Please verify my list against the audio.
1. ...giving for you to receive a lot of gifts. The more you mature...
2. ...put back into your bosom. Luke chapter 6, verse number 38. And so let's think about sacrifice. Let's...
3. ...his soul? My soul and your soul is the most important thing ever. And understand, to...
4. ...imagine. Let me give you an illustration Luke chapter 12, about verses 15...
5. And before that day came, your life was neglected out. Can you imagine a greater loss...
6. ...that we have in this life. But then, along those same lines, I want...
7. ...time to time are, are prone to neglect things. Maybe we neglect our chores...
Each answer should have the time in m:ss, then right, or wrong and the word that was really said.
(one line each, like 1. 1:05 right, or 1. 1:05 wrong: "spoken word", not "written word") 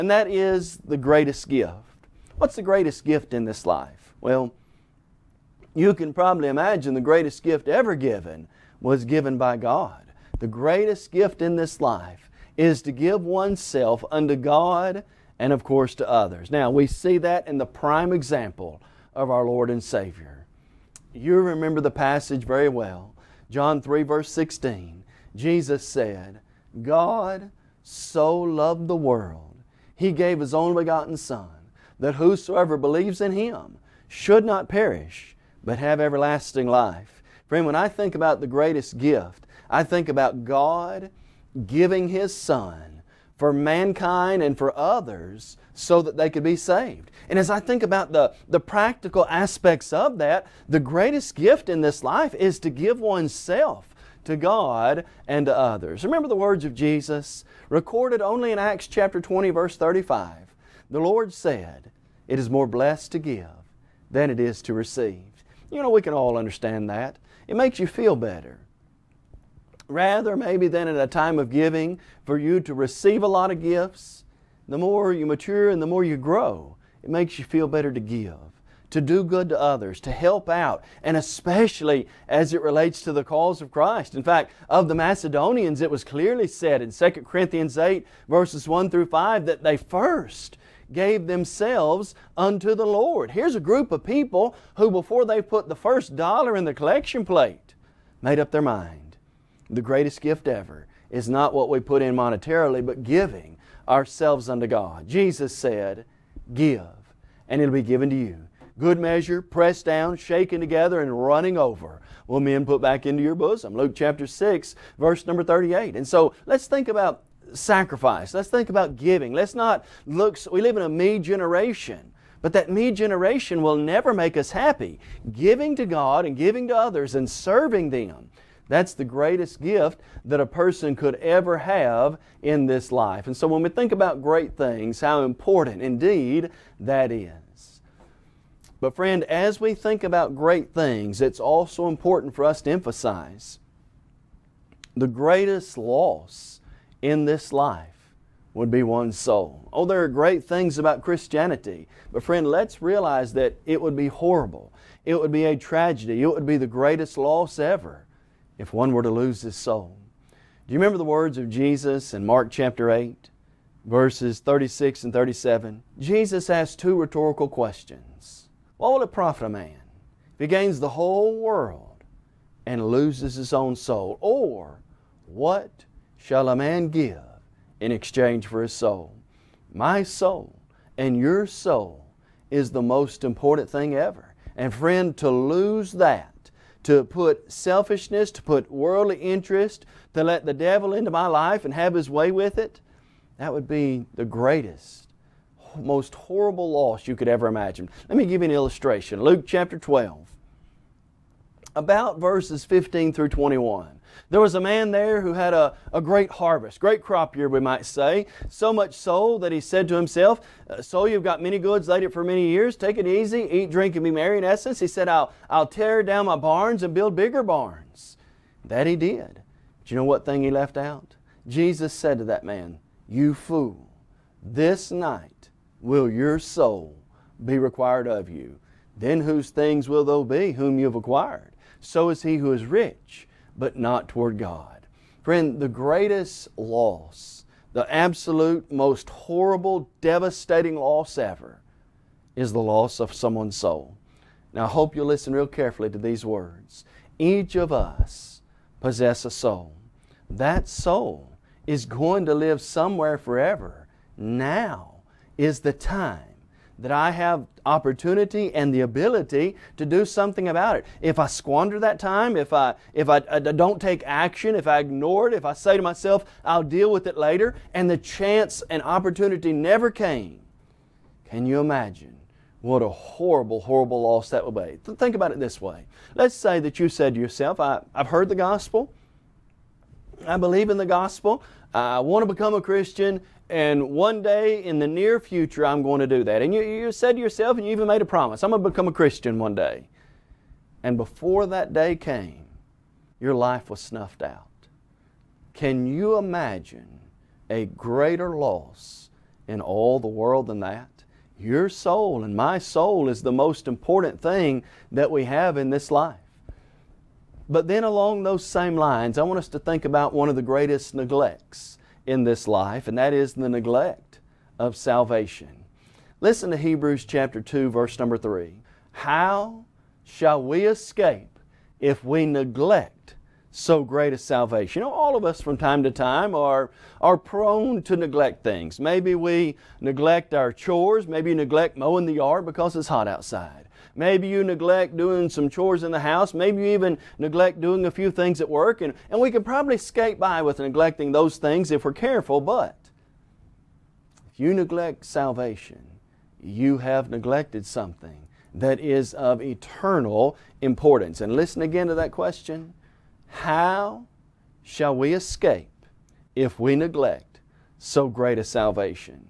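1. 1:11 right
2. 1:52 right
3. 2:58 wrong: "friend", not "understand"
4. 3:17 right
5. 4:50 wrong: "snuffed", not "neglected"
6. 5:04 right
7. 5:25 right.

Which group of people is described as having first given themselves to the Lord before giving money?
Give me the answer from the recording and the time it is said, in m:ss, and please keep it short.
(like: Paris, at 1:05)
The Macedonians, at 1:24.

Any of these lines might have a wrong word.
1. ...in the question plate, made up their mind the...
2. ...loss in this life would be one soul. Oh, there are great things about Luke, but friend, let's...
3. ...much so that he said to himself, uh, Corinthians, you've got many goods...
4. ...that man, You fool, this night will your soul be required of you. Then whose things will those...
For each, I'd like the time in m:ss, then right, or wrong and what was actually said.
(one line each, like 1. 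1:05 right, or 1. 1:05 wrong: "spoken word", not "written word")
1. 1:36 wrong: "collection", not "question"
2. 2:25 wrong: "Christianity", not "Luke"
3. 3:28 wrong: "Soul", not "Corinthians"
4. 3:42 right.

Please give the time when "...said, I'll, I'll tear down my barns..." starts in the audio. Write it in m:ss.
3:34.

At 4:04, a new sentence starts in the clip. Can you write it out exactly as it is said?
Now, I hope you'll listen real carefully to these words.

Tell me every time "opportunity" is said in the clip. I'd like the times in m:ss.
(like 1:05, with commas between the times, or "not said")
4:17, 4:28.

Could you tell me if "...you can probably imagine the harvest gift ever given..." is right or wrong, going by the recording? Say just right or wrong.
wrong.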